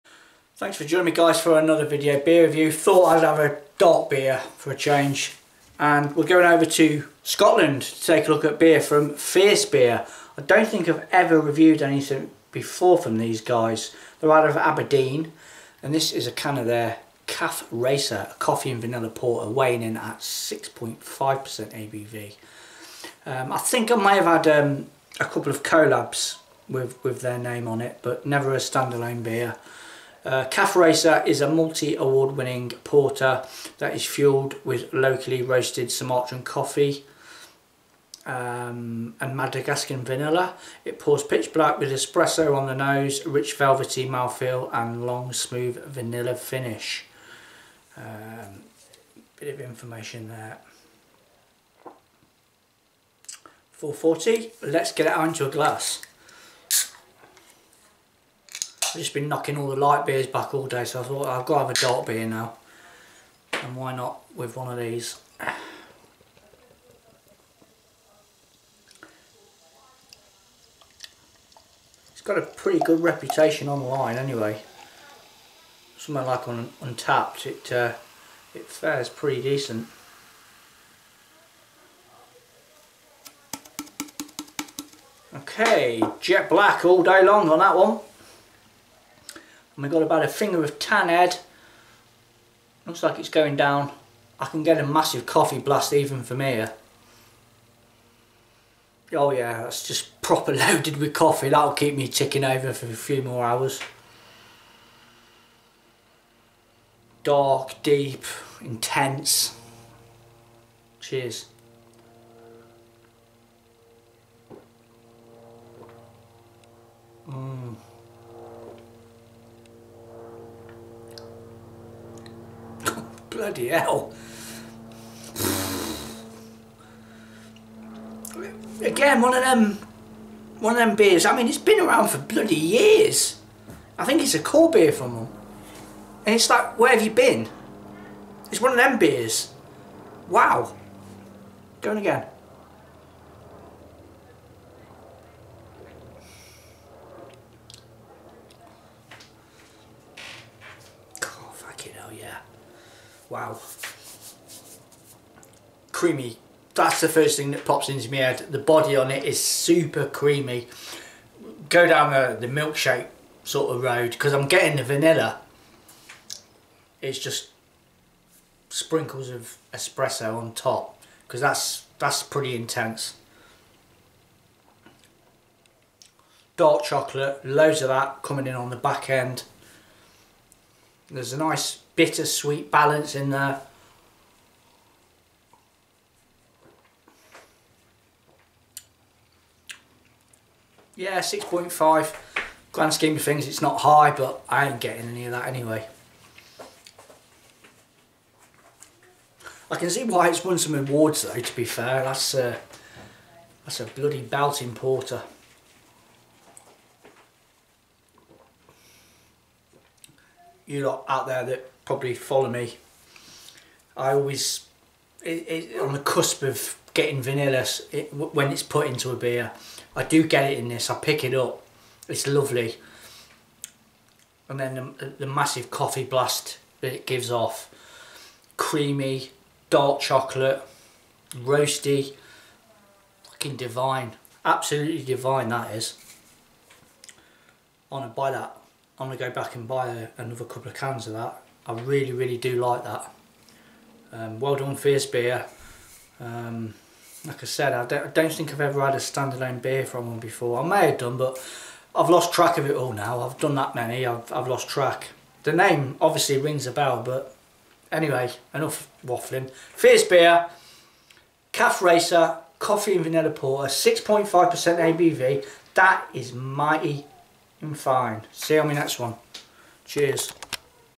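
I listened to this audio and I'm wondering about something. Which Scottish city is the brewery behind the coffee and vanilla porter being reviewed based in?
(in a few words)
Aberdeen.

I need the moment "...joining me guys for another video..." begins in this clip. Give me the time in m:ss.
0:00.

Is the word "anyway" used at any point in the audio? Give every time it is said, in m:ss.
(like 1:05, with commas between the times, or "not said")
1:14, 3:15, 4:17.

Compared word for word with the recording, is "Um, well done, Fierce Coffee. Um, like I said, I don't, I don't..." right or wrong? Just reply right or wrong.
wrong.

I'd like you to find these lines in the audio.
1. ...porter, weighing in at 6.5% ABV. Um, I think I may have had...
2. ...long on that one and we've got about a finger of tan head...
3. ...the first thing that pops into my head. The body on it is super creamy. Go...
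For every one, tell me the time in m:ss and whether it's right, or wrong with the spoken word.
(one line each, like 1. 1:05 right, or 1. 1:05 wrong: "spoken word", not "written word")
1. 0:19 right
2. 1:27 right
3. 2:36 right.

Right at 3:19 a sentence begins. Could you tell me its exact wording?
I can see why it's won some awards though, to be fair.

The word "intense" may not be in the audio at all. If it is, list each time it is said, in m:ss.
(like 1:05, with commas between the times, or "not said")
1:48, 2:52.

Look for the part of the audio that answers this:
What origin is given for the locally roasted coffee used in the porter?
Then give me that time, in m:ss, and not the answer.
0:35.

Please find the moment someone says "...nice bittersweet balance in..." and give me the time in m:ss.
3:01.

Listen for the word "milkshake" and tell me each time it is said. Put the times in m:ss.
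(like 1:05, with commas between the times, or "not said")
2:42.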